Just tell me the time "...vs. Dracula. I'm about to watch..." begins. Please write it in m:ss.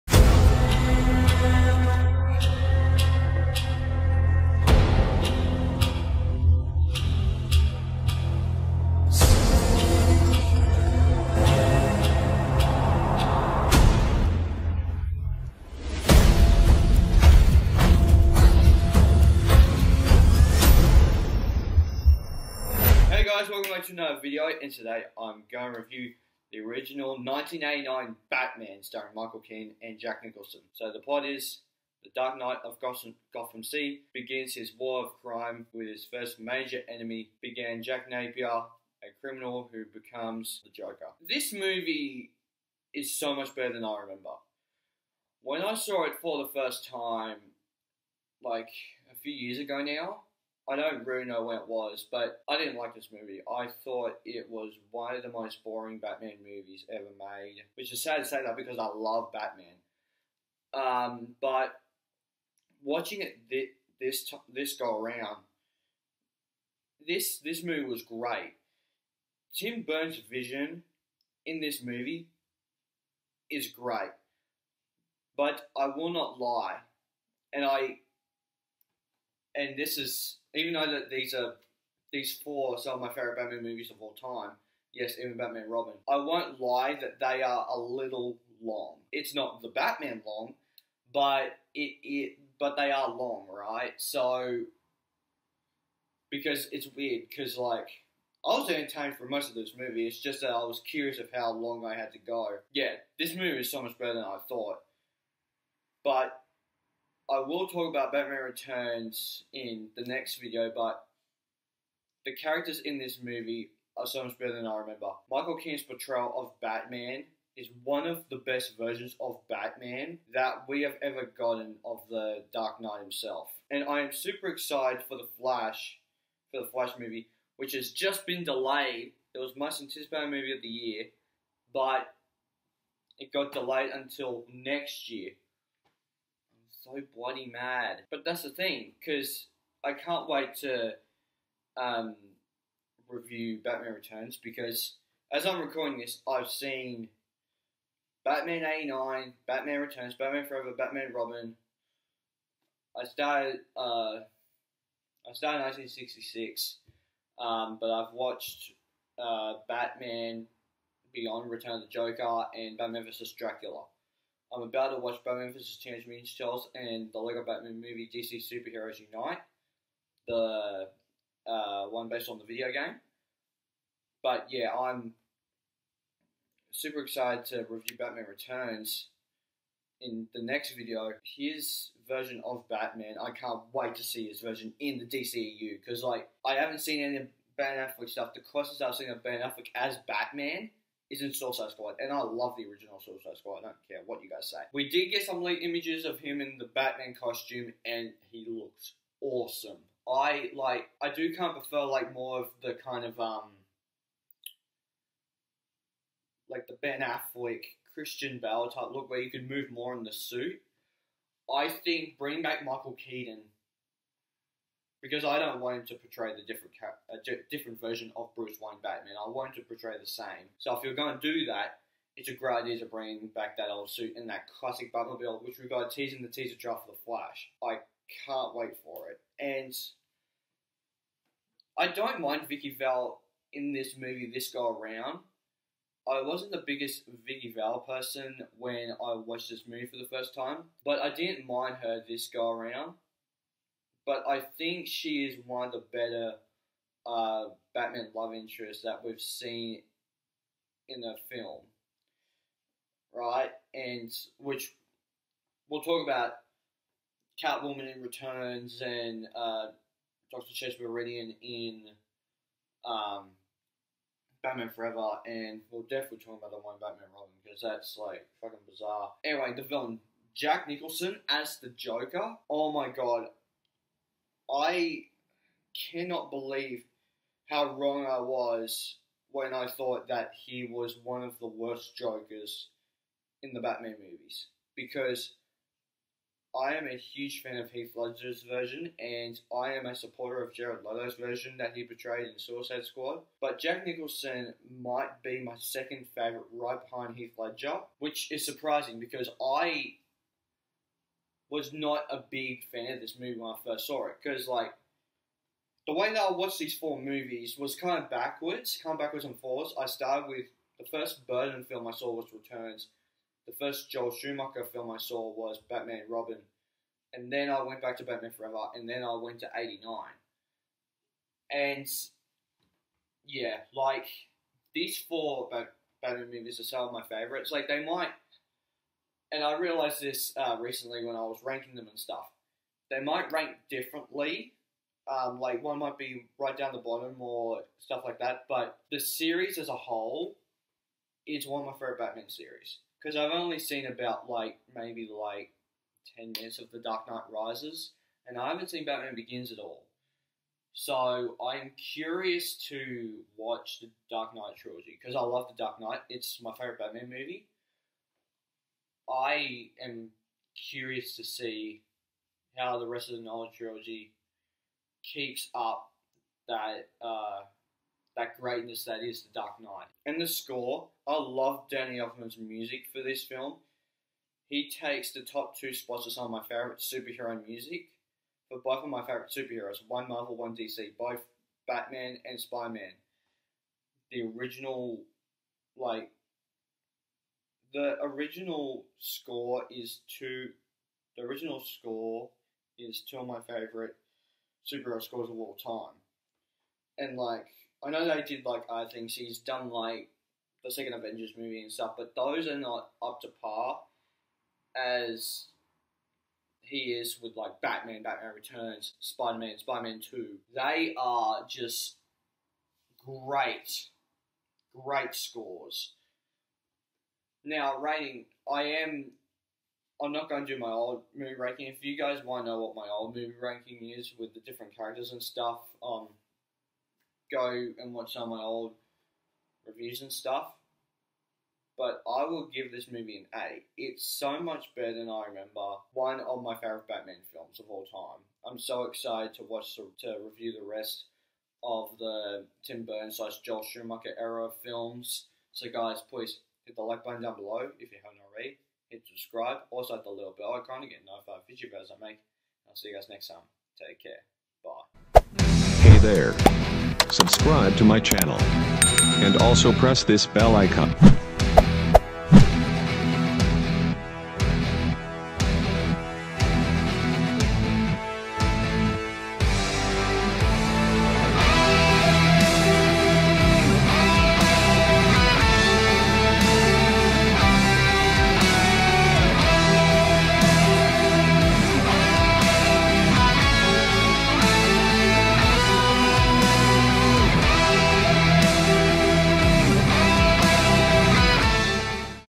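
2:43.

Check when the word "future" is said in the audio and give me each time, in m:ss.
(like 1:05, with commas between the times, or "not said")
7:31.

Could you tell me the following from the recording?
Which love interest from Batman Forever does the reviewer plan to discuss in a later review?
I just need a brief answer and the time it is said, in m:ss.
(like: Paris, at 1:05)
Doctor Chase Meridian, at 4:20.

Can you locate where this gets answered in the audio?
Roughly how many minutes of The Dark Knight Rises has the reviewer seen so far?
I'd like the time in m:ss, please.
5:46.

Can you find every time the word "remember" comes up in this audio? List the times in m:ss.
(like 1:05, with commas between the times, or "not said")
0:43, 1:54, 7:15.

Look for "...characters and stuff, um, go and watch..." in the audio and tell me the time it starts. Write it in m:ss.
7:04.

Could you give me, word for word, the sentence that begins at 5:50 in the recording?
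So I'm curious to watch the Dark Knight trilogy because I love the Dark Knight.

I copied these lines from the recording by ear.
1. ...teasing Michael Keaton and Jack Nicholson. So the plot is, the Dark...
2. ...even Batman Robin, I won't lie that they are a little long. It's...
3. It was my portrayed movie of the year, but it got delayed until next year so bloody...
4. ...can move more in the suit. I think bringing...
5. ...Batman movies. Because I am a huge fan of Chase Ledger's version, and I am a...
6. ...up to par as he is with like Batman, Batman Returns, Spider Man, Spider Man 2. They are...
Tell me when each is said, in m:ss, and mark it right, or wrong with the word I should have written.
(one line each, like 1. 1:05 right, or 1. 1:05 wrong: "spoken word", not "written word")
1. 0:28 wrong: "starring", not "teasing"
2. 1:25 right
3. 2:09 wrong: "anticipated", not "portrayed"
4. 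3:29 right
5. 4:43 wrong: "Heath", not "Chase"
6. 6:43 right.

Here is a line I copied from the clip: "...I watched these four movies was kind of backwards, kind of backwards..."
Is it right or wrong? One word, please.
right.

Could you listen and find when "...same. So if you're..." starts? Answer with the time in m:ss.
3:40.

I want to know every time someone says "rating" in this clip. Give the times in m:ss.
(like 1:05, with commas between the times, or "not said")
6:57.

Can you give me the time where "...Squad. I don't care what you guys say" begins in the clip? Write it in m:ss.
3:13.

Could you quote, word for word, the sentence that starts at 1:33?
So because it's weird, because like I was entertained for most of this movie.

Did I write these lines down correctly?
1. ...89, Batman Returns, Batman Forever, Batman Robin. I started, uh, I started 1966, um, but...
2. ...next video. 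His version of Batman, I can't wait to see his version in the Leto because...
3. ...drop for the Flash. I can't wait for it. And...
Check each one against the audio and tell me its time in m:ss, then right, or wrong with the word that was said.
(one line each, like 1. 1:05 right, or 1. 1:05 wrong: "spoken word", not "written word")
1. 2:28 right
2. 3:00 wrong: "DCEU", not "Leto"
3. 3:46 right.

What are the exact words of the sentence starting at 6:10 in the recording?
And the score, I love Danny Elfman's music for this film.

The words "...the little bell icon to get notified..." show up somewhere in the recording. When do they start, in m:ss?
7:30.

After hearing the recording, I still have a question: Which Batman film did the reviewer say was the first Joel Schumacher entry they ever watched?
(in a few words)
Batman and Robin.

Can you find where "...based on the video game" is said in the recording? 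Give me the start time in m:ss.
2:52.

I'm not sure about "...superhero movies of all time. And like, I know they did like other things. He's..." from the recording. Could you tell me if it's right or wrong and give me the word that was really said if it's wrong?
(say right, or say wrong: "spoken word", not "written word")
wrong: "scores", not "movies".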